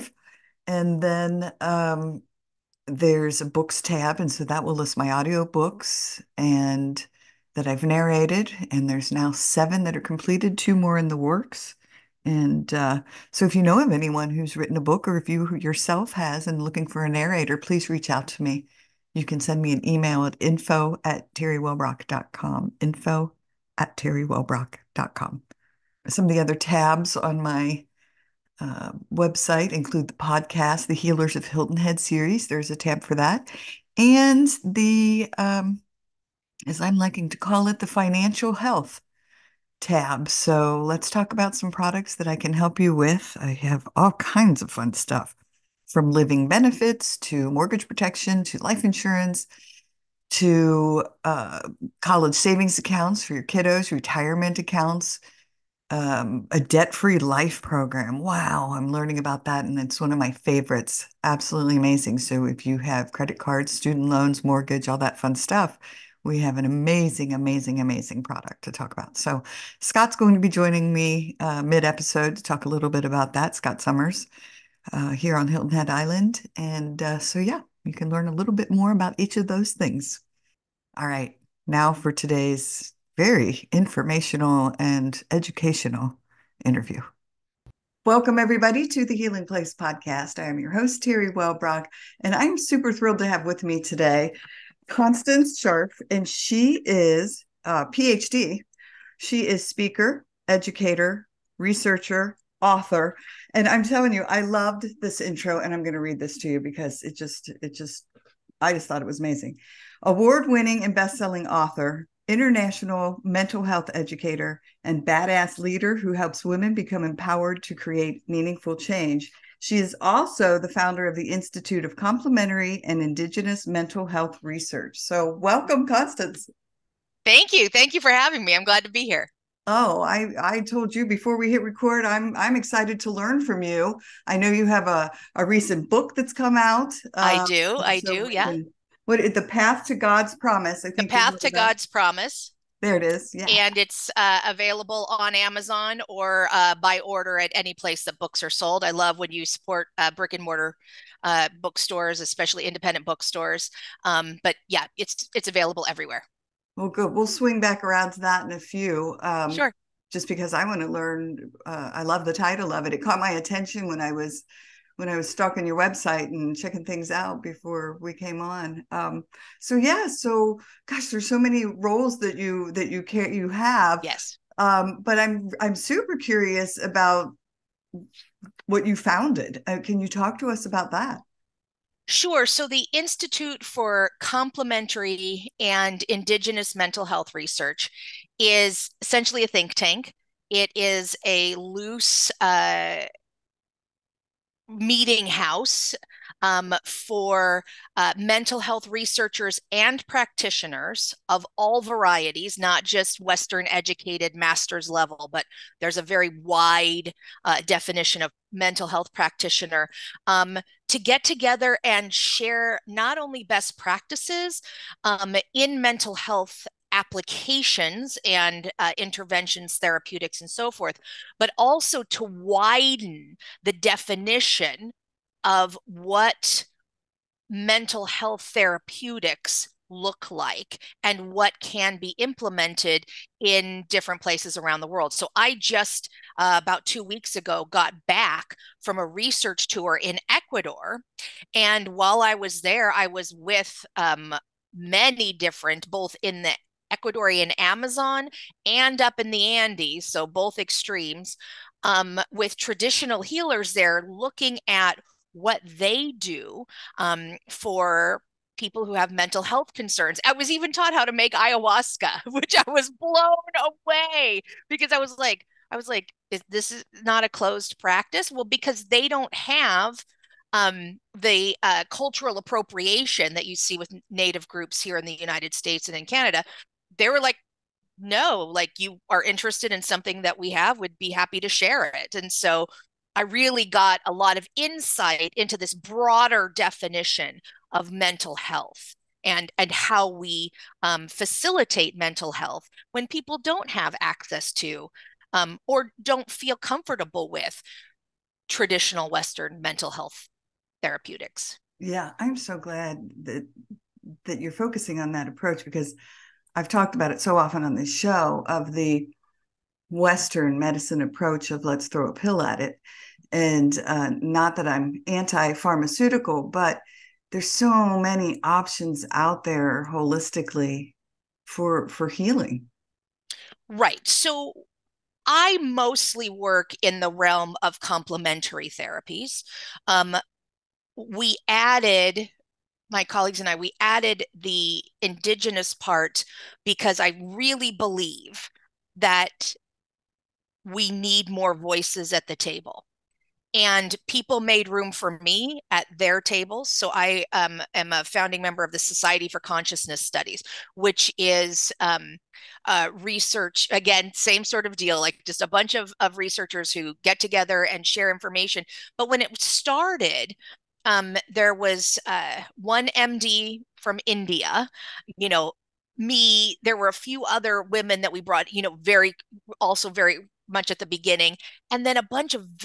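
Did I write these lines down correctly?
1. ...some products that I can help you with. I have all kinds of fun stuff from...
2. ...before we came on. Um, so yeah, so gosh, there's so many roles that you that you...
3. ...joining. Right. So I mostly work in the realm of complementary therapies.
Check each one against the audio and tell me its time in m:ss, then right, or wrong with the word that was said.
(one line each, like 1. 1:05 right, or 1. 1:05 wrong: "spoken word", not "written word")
1. 0:41 right
2. 2:47 right
3. 5:22 wrong: "healing", not "joining".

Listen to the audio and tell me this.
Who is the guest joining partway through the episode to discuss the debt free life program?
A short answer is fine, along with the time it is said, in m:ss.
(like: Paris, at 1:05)
Scott Summers, at 1:13.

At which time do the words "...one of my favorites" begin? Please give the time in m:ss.
0:59.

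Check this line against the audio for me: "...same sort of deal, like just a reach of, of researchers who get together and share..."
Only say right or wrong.
wrong.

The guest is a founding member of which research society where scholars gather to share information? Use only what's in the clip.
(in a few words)
Society for Consciousness Studies.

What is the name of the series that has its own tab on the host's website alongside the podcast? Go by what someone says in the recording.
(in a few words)
Healers of Hilton Head.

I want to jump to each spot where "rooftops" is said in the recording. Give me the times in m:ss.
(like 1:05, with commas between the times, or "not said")
not said.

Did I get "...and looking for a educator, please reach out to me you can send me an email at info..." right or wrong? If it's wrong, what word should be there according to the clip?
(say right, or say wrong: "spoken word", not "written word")
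wrong: "narrator", not "educator".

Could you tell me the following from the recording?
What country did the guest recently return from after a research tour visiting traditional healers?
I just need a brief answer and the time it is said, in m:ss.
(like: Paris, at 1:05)
Ecuador, at 4:00.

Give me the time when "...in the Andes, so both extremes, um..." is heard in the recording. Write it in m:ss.
4:09.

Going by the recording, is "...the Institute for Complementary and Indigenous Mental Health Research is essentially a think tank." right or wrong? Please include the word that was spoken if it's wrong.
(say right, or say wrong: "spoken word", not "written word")
right.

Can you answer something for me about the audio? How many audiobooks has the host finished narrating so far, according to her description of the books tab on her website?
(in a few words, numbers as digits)
7.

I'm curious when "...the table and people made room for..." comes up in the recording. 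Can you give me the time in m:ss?
5:42.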